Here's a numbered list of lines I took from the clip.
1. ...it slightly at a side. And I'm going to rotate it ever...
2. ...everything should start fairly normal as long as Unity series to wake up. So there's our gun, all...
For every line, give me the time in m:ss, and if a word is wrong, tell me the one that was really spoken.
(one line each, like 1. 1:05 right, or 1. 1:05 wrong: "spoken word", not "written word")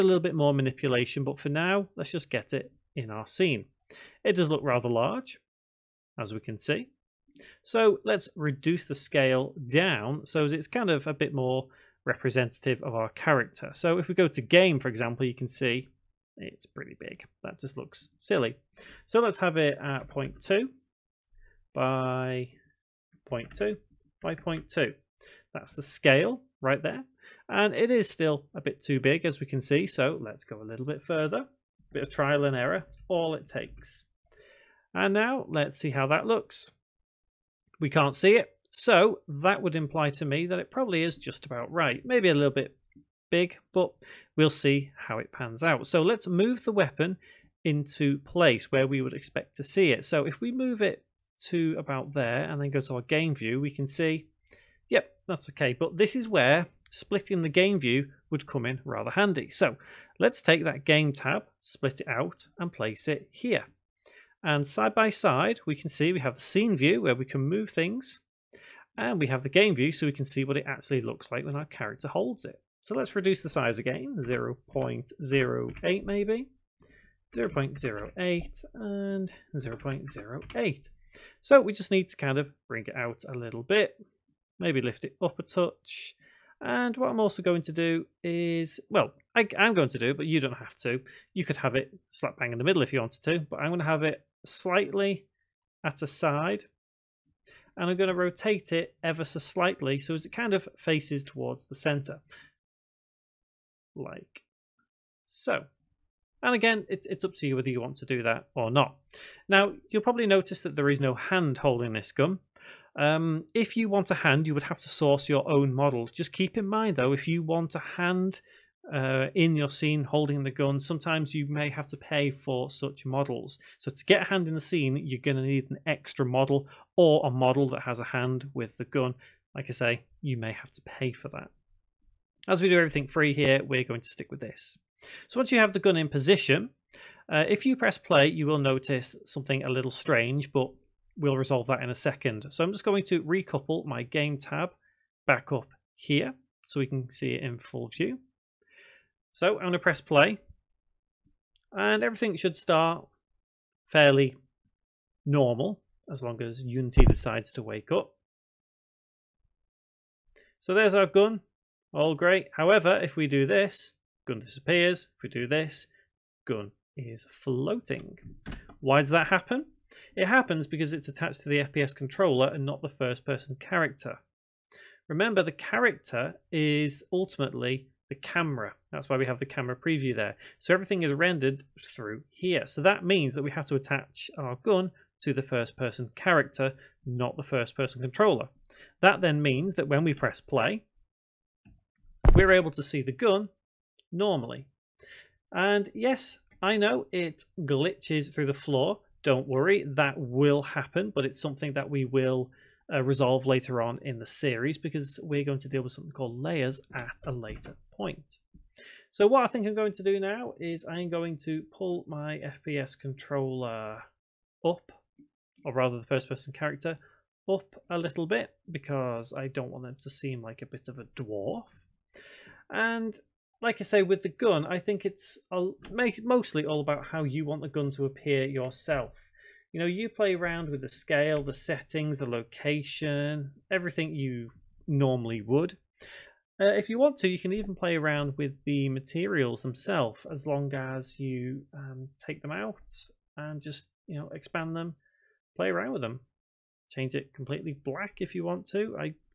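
1. 1:34 right
2. 2:32 wrong: "decides", not "series".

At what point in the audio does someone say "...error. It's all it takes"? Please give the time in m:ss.
0:32.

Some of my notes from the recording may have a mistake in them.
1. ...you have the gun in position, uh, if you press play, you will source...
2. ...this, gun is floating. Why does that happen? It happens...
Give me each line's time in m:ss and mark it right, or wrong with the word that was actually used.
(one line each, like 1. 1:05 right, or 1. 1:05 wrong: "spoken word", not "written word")
1. 2:15 wrong: "notice", not "source"
2. 2:45 right.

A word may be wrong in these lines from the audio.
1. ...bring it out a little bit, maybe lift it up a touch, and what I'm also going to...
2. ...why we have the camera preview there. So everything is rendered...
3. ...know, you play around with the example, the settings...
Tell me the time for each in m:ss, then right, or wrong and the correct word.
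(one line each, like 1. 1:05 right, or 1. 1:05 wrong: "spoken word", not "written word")
1. 1:22 right
2. 2:59 right
3. 3:49 wrong: "scale", not "example".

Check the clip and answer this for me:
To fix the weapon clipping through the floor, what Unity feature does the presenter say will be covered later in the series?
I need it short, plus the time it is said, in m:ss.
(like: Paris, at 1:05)
layers, at 3:26.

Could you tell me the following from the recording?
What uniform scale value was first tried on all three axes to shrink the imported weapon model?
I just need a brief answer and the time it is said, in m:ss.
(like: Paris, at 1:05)
0.2, at 0:20.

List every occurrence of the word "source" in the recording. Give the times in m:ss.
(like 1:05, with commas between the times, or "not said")
1:54.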